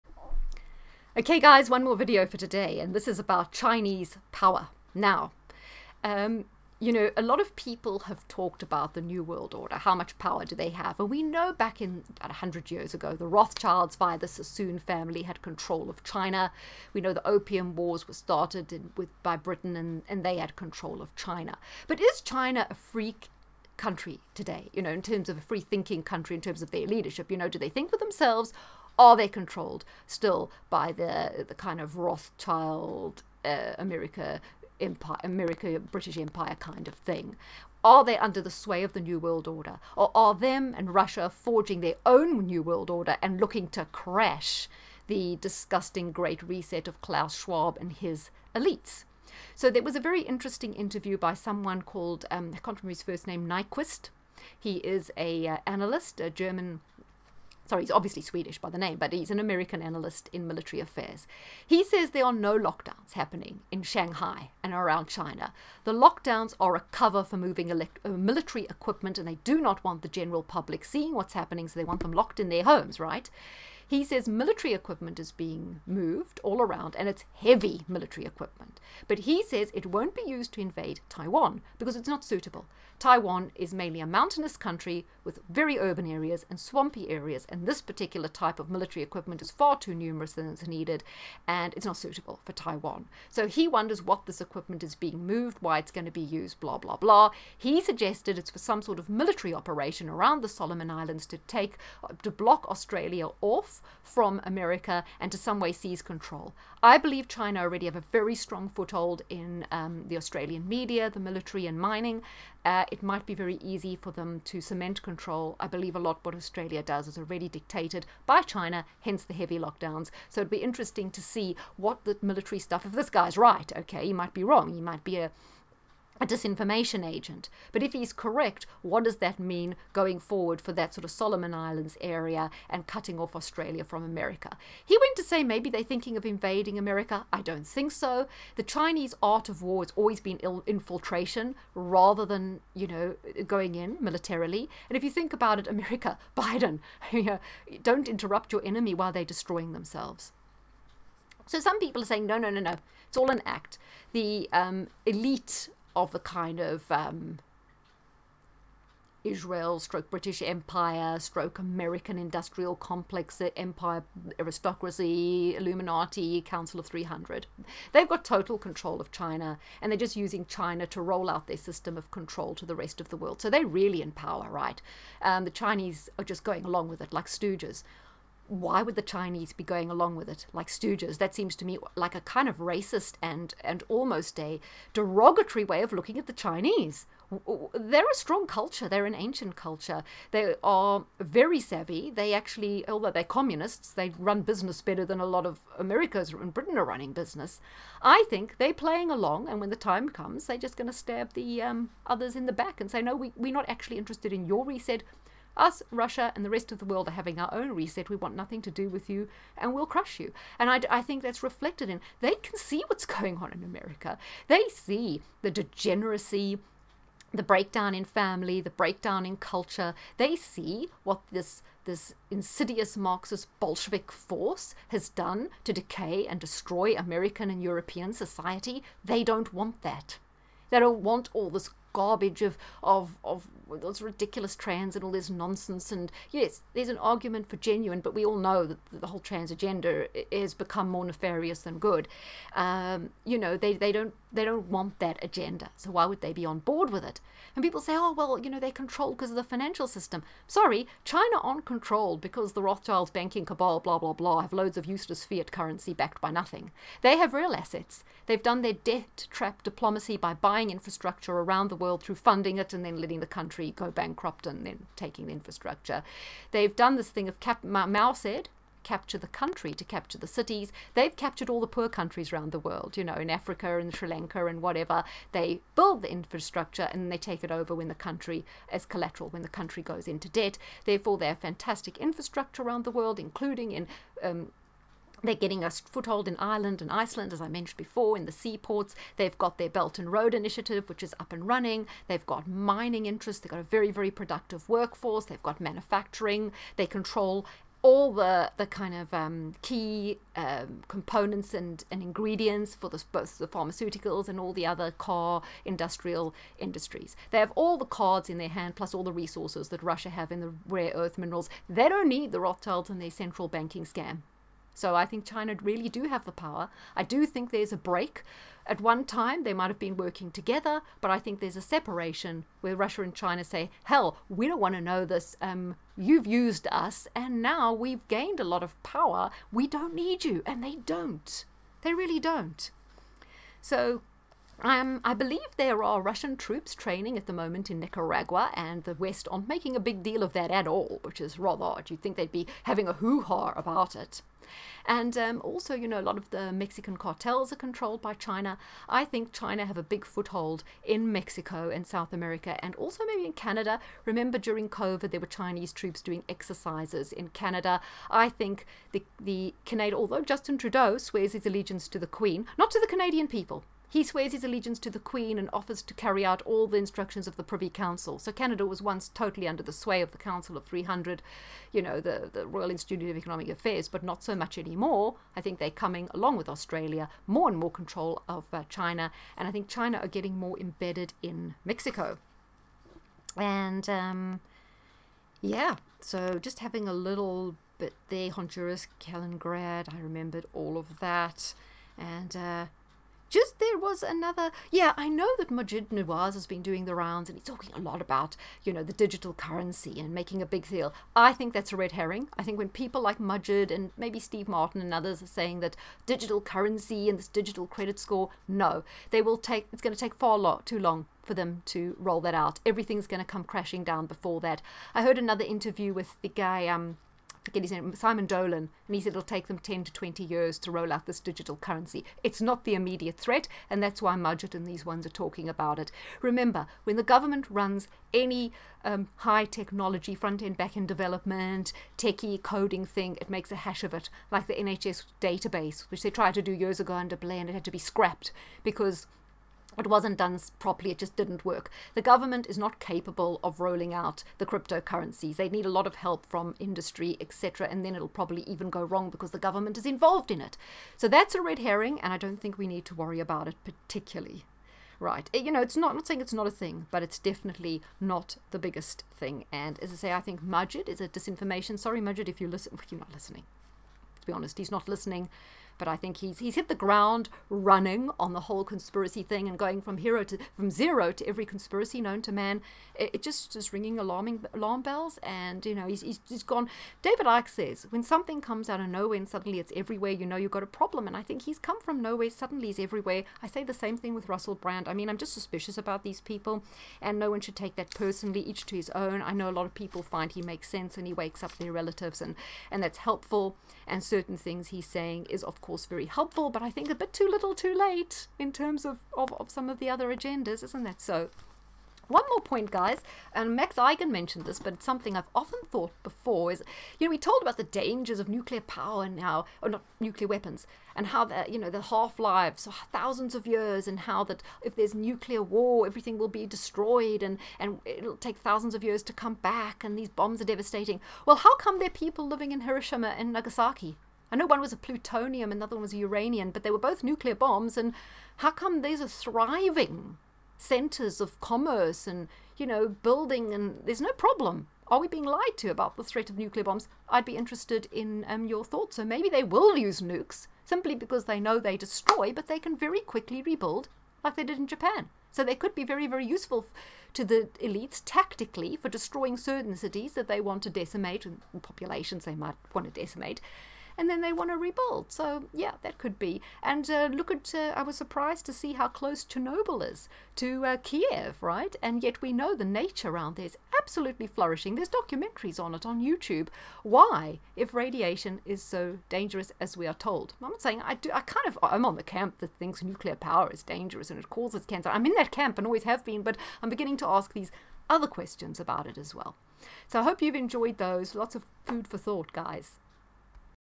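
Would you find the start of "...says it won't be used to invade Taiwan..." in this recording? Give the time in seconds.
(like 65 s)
79 s.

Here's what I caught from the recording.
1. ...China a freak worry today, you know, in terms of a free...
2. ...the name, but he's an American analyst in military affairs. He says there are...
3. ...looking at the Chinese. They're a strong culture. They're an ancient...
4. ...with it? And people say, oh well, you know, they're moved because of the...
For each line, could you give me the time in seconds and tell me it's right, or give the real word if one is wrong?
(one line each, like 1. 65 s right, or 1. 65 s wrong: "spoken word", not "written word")
1. 22 s wrong: "country", not "worry"
2. 58 s right
3. 185 s right
4. 246 s wrong: "controlled", not "moved".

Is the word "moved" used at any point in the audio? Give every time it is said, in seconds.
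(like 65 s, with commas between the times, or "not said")
75 s, 95 s.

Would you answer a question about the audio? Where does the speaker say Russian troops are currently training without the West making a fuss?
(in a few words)
Nicaragua.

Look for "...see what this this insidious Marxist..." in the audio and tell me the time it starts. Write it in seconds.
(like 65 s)
220 s.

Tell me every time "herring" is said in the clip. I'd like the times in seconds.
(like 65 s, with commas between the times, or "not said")
401 s, 451 s.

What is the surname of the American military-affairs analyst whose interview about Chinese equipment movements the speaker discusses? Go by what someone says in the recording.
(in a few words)
Nyquist.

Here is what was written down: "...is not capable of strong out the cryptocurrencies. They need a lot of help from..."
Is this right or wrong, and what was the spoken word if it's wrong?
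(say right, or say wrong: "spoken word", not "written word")
wrong: "rolling", not "strong".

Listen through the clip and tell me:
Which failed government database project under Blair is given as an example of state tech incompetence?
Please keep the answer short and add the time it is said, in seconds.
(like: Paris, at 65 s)
NHS database, at 434 s.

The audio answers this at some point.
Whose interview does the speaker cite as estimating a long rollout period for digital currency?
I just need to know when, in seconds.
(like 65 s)
417 s.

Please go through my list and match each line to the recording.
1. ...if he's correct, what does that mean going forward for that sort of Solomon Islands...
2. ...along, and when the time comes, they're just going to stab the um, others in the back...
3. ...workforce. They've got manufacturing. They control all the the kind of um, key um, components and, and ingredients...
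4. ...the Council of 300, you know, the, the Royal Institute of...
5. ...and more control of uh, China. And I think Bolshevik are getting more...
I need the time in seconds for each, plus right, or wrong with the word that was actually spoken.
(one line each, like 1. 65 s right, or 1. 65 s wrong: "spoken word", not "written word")
1. 127 s right
2. 199 s right
3. 294 s right
4. 370 s right
5. 377 s wrong: "China", not "Bolshevik".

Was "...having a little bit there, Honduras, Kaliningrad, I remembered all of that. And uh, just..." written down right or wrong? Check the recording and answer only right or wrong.
right.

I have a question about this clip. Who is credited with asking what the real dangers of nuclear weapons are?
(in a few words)
Max Igan.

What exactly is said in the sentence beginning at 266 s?
They've done this thing of cap- Mao said, capture the country, to capture the cities.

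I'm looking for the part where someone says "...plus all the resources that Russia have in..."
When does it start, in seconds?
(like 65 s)
308 s.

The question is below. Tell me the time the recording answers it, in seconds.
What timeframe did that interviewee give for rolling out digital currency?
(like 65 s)
419 s.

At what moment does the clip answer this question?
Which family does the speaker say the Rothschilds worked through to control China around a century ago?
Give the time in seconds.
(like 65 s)
14 s.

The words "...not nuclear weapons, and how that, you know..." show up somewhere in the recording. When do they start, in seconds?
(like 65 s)
509 s.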